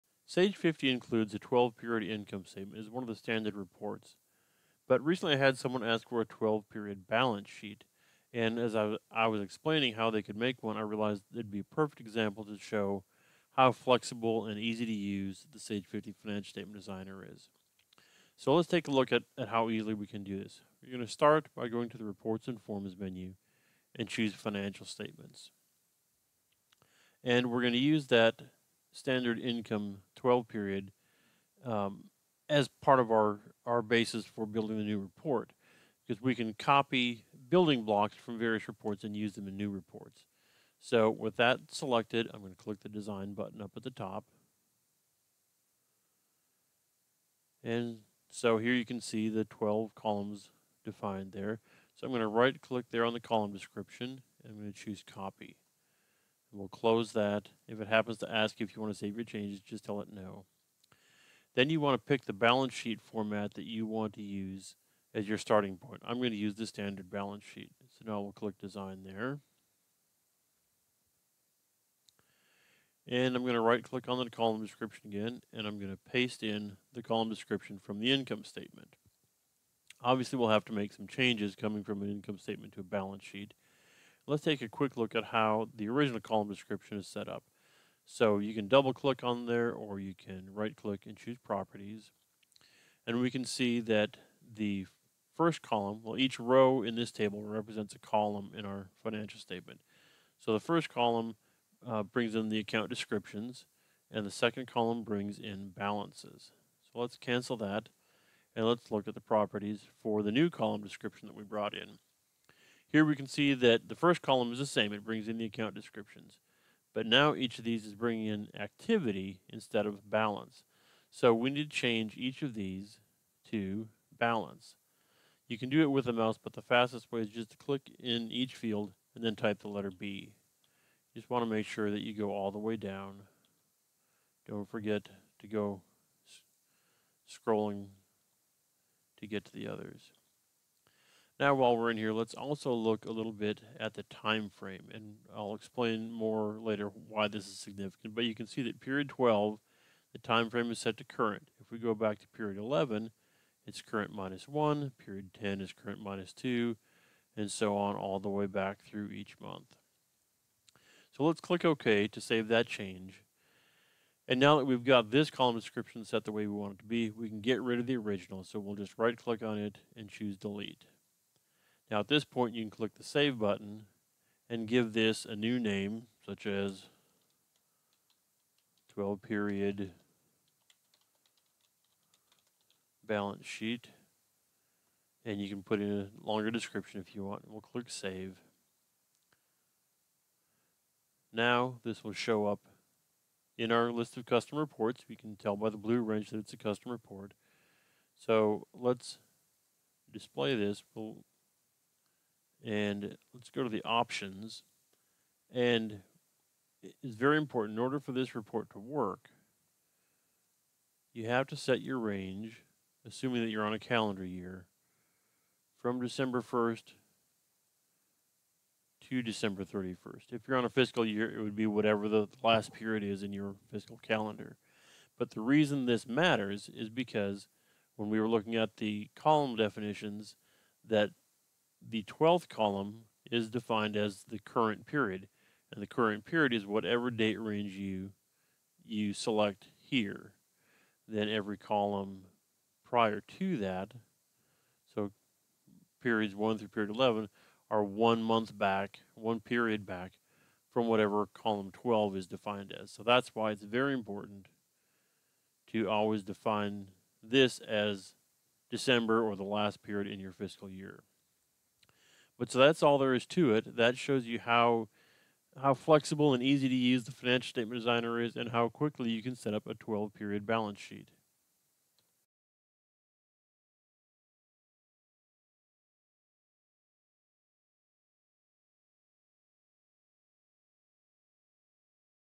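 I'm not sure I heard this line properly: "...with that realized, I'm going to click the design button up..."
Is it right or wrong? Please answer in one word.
wrong.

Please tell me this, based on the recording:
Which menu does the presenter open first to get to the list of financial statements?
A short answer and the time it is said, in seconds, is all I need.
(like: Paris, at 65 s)
Reports and Forms, at 22 s.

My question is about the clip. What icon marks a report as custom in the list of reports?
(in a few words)
blue wrench.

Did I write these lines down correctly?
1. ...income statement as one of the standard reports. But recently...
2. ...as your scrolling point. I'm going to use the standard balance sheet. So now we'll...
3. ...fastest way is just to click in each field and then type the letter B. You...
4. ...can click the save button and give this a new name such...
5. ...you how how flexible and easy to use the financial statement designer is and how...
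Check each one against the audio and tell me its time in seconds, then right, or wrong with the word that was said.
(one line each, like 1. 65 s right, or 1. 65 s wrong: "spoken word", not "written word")
1. 2 s right
2. 65 s wrong: "starting", not "scrolling"
3. 126 s right
4. 172 s right
5. 264 s right.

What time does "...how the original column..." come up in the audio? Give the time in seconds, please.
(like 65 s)
85 s.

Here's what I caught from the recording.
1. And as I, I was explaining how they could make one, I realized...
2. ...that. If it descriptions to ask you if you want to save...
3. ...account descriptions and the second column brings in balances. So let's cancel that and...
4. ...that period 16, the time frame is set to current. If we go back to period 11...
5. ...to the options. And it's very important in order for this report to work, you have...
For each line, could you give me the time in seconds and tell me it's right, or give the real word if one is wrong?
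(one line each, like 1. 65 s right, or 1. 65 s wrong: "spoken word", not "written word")
1. 8 s right
2. 57 s wrong: "happens", not "descriptions"
3. 102 s right
4. 148 s wrong: "12", not "16"
5. 203 s right.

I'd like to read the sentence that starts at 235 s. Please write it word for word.
And the current period is whatever date range you you select here.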